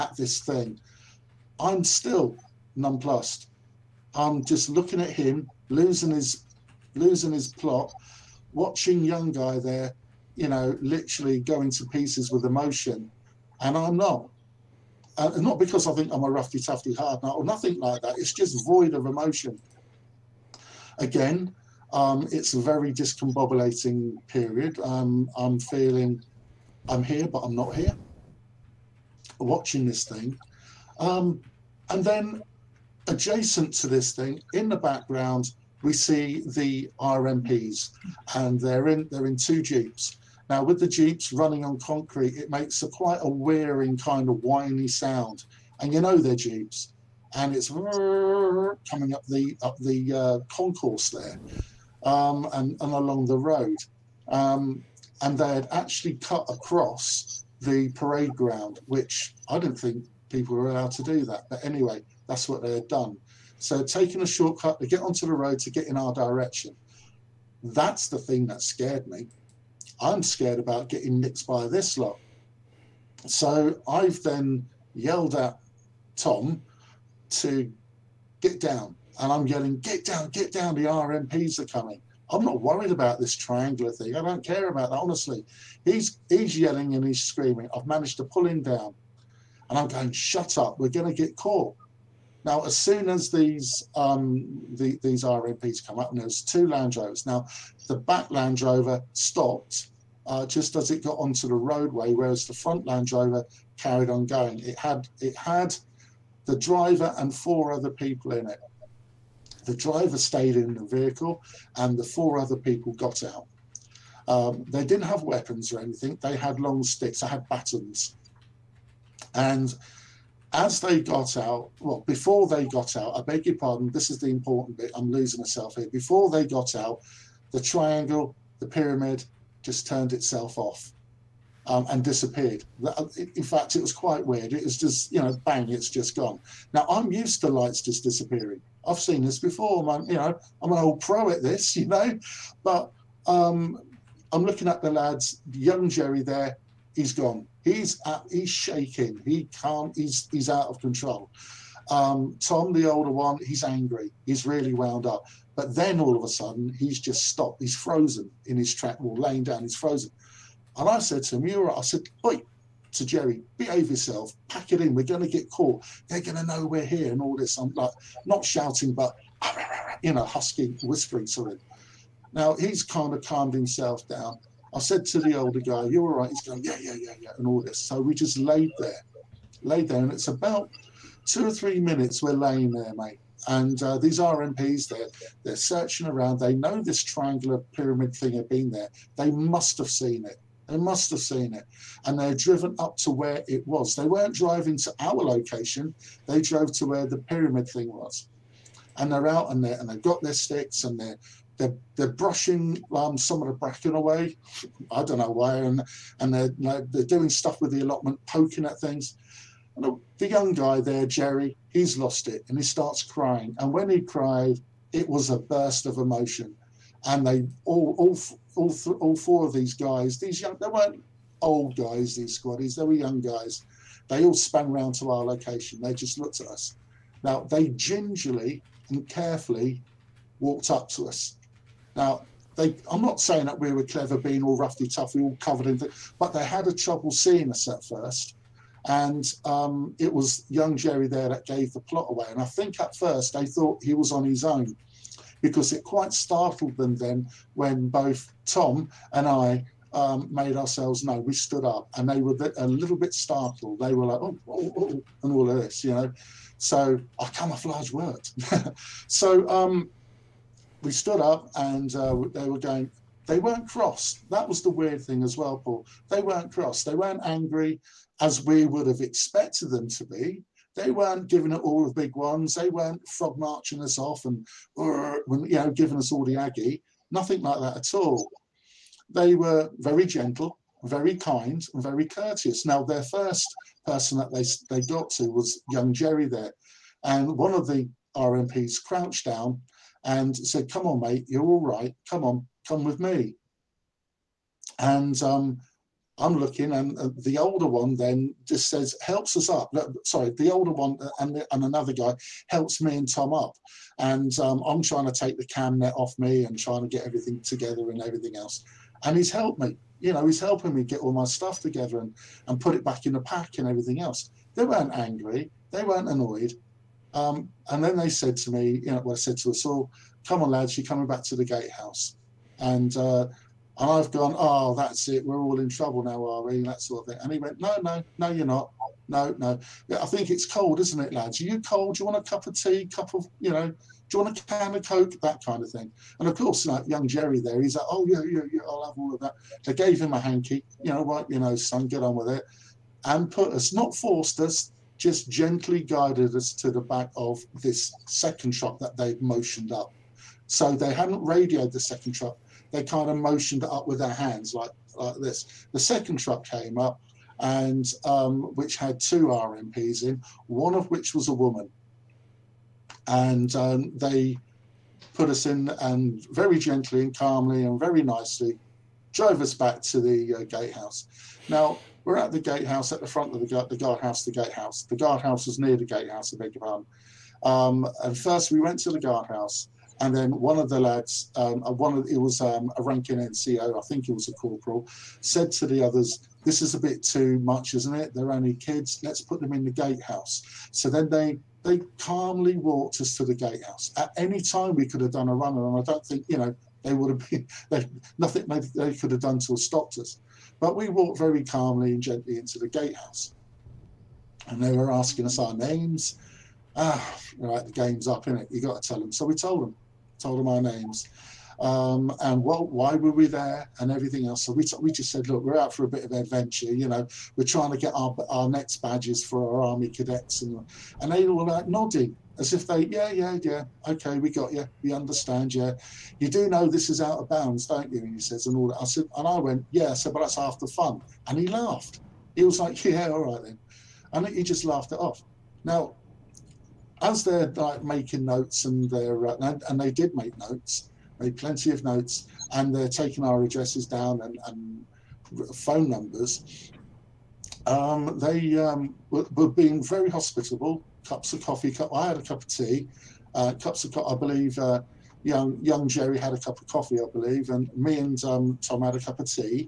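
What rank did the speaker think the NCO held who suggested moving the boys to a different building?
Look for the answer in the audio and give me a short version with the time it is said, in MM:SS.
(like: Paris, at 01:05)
Corporal, at 06:24.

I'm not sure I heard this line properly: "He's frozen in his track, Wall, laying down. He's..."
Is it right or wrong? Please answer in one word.
right.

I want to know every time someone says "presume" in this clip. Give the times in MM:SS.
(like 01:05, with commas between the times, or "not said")
not said.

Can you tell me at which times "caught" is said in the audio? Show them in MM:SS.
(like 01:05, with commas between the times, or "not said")
01:31, 02:45.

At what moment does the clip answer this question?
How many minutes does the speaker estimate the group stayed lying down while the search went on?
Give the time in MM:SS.
03:01.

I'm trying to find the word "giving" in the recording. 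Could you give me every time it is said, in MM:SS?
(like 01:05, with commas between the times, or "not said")
04:31, 04:35.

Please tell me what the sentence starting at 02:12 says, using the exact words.
Uh, in fact, it was quite weird.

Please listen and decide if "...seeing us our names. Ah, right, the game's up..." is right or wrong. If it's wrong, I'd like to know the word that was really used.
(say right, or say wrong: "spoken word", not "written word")
wrong: "asking", not "seeing".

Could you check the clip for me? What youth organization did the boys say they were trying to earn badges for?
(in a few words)
Army cadets.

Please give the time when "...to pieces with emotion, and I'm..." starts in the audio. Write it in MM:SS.
00:11.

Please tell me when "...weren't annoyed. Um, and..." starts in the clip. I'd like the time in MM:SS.
05:15.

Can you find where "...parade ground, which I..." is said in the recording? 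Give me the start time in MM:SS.
00:57.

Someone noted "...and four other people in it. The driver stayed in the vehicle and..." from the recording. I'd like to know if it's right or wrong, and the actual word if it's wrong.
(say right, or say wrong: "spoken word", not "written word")
right.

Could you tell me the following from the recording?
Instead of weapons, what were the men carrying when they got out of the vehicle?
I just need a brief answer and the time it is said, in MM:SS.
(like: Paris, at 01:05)
Batons, at 01:57.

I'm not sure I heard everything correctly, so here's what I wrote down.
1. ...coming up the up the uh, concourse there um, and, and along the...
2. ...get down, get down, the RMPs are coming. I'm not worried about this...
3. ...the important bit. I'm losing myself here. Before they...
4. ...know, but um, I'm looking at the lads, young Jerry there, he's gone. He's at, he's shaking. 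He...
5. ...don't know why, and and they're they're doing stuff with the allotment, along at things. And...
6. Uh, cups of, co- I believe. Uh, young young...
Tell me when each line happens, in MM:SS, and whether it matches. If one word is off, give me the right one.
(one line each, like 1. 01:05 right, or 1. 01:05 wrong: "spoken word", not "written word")
1. 00:47 right
2. 01:19 right
3. 02:04 right
4. 02:21 right
5. 03:25 wrong: "poking", not "along"
6. 07:33 right.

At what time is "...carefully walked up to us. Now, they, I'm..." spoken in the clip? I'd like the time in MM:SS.
03:49.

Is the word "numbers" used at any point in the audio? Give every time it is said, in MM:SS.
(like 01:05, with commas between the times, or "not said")
07:25.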